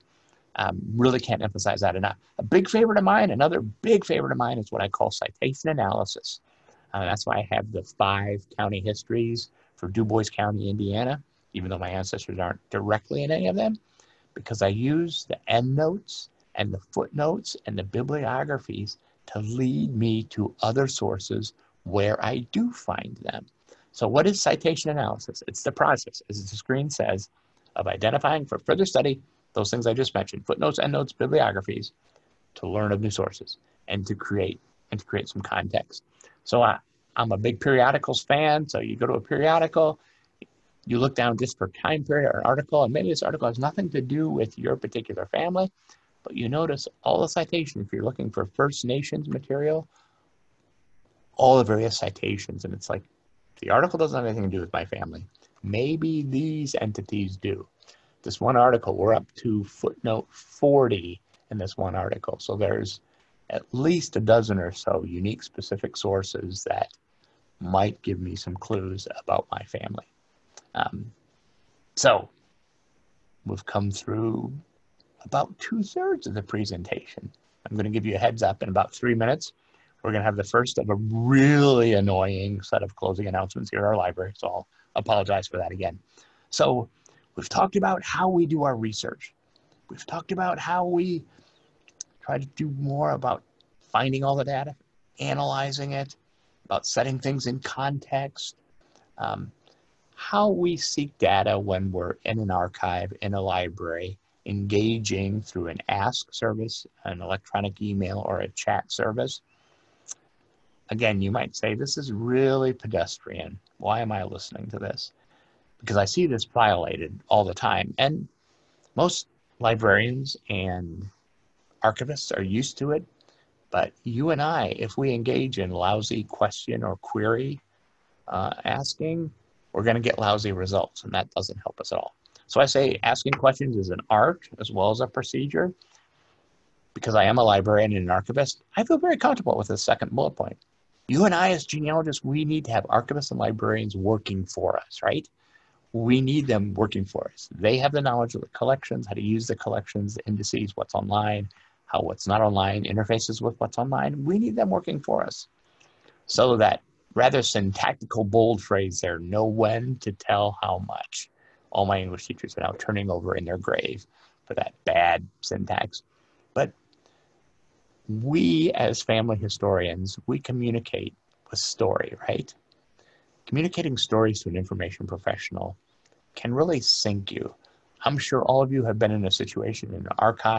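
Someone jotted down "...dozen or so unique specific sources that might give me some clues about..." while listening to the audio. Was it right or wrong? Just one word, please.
right.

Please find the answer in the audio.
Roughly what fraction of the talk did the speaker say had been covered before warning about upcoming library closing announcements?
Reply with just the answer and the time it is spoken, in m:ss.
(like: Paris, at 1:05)
two thirds, at 1:15.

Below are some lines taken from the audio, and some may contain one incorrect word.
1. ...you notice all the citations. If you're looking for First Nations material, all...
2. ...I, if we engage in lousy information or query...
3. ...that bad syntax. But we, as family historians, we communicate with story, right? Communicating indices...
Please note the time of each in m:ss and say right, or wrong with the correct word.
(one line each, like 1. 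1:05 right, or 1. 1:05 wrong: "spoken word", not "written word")
1. 0:46 right
2. 2:04 wrong: "question", not "information"
3. 2:44 wrong: "stories", not "indices".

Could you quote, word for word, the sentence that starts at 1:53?
Why am I listening to this?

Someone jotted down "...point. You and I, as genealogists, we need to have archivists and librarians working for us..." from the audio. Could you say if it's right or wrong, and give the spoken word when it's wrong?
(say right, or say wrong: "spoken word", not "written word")
right.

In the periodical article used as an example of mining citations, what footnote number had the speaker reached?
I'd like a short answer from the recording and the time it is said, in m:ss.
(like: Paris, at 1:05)
40, at 1:00.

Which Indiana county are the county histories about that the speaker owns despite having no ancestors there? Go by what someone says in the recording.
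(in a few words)
Dubois County.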